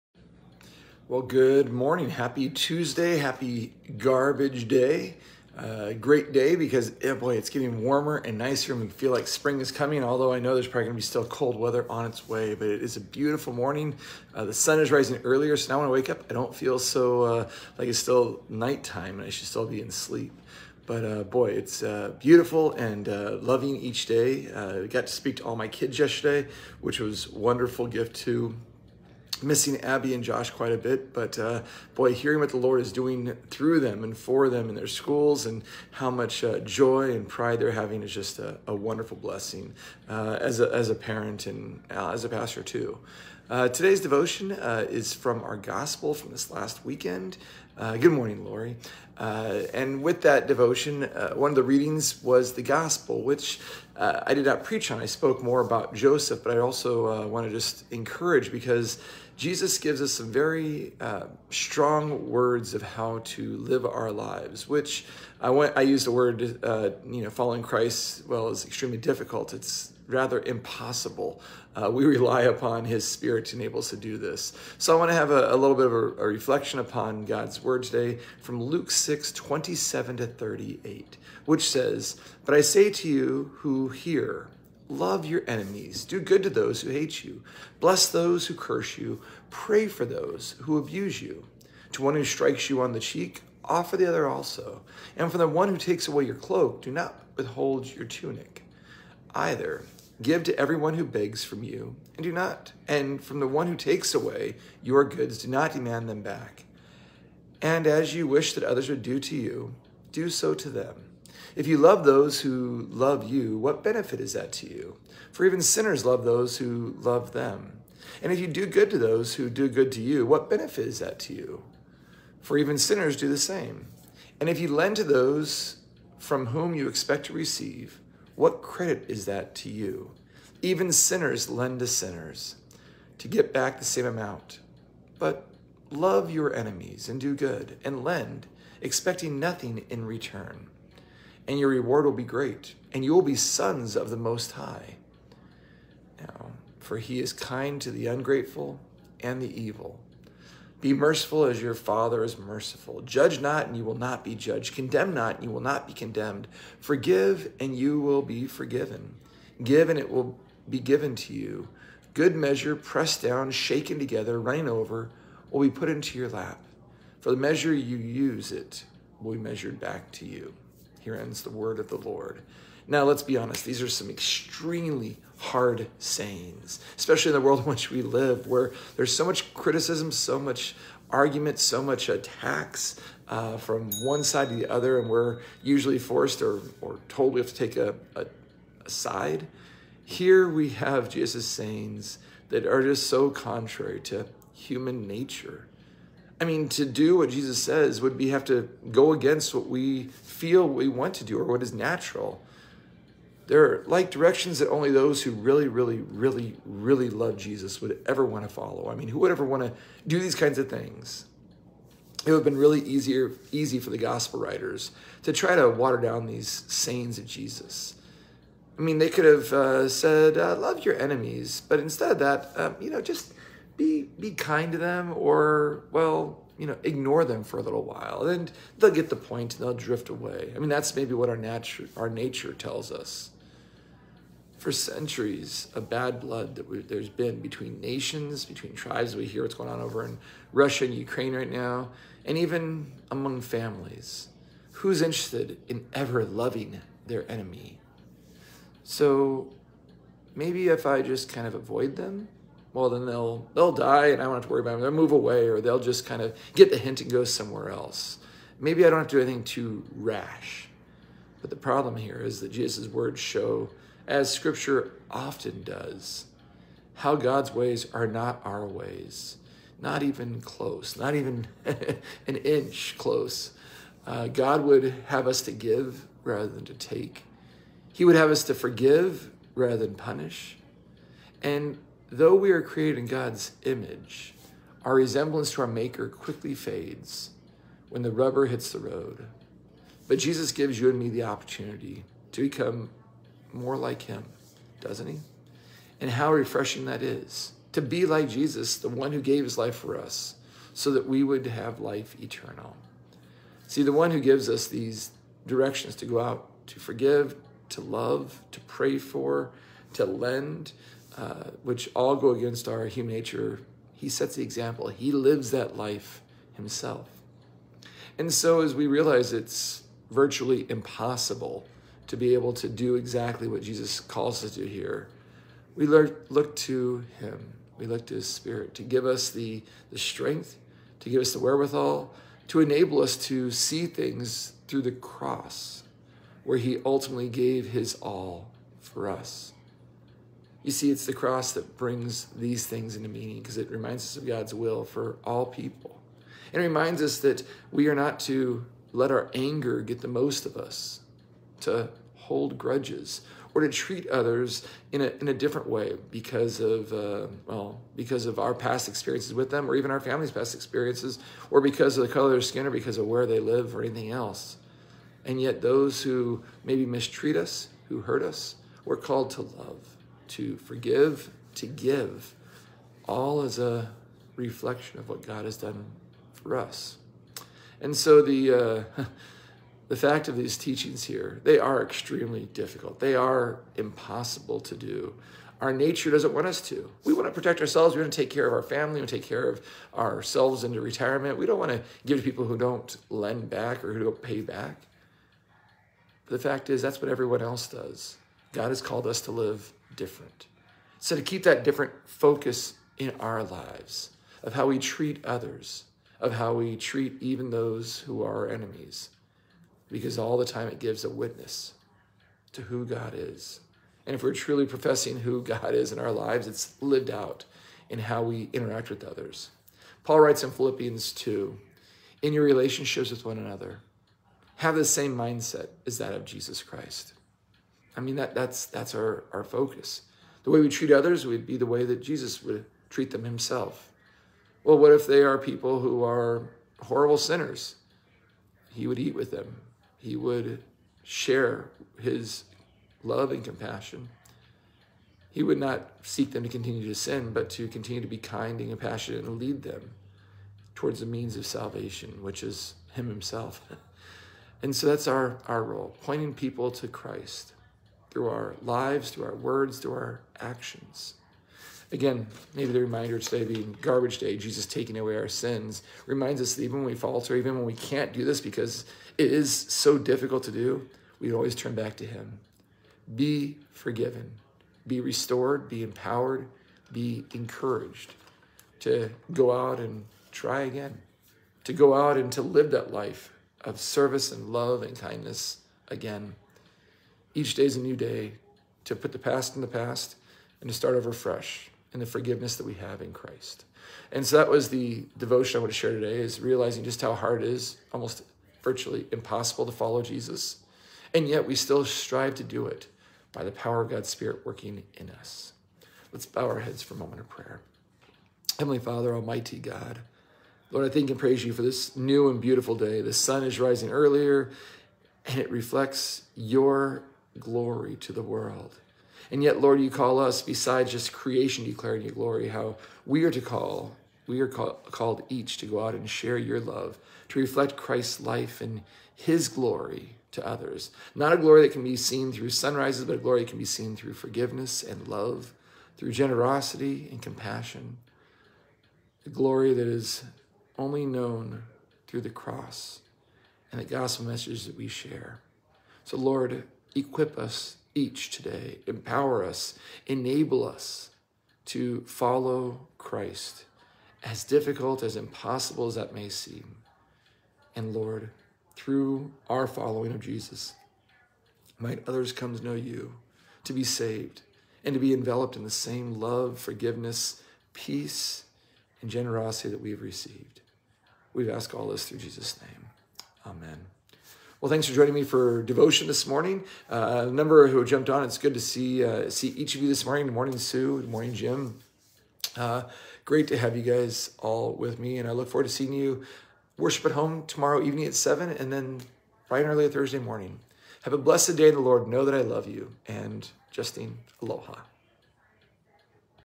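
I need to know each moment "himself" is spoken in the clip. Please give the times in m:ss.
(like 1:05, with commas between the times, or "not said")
5:16, 7:13, 7:33.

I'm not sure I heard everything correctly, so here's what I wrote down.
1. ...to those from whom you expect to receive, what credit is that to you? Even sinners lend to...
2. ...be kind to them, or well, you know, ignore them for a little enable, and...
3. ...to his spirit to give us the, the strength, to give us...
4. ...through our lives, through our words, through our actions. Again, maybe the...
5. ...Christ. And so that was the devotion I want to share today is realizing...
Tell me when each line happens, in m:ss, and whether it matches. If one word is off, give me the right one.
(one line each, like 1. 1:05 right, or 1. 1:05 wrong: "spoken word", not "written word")
1. 2:04 right
2. 3:44 wrong: "while", not "enable"
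3. 5:28 right
4. 7:38 right
5. 8:13 right.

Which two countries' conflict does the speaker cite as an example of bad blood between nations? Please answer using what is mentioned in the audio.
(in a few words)
Russia and Ukraine.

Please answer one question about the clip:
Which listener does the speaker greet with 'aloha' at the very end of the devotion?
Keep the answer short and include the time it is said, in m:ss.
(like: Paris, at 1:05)
Justine, at 9:53.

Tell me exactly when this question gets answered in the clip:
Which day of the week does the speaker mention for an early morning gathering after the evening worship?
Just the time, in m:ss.
9:49.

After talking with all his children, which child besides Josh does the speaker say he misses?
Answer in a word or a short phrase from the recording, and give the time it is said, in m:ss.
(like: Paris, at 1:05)
Abby, at 0:29.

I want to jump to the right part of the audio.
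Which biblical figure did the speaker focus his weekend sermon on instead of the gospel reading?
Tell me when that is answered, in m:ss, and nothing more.
0:55.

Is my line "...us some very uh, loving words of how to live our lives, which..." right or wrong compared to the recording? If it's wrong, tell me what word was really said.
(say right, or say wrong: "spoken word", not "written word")
wrong: "strong", not "loving".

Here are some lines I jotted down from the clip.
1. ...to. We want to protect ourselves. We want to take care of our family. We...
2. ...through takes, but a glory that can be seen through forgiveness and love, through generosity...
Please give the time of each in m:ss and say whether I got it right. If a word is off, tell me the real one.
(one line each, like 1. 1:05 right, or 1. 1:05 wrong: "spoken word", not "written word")
1. 6:26 right
2. 8:52 wrong: "sunrises", not "takes".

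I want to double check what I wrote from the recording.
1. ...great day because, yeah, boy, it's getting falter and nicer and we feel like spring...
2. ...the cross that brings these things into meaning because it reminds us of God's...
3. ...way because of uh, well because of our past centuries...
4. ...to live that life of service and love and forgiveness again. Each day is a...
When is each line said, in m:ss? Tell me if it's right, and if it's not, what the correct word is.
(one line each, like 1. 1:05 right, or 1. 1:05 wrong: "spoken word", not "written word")
1. 0:05 wrong: "warmer", not "falter"
2. 5:41 right
3. 5:55 wrong: "experiences", not "centuries"
4. 8:02 wrong: "kindness", not "forgiveness".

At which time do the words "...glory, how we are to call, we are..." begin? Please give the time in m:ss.
8:42.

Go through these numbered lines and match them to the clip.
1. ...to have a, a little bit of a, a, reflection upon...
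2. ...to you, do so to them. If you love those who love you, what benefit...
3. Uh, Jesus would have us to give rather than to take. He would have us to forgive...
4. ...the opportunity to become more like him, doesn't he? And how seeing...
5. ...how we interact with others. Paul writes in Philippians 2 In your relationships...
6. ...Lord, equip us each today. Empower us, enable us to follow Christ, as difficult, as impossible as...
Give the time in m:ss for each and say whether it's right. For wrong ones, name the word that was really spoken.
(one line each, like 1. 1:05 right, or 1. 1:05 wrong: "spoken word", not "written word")
1. 1:15 right
2. 1:49 right
3. 4:34 wrong: "God", not "Jesus"
4. 4:51 wrong: "refreshing", not "seeing"
5. 6:57 right
6. 9:06 right.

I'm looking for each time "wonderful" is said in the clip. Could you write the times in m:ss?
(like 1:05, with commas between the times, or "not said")
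0:27, 0:38.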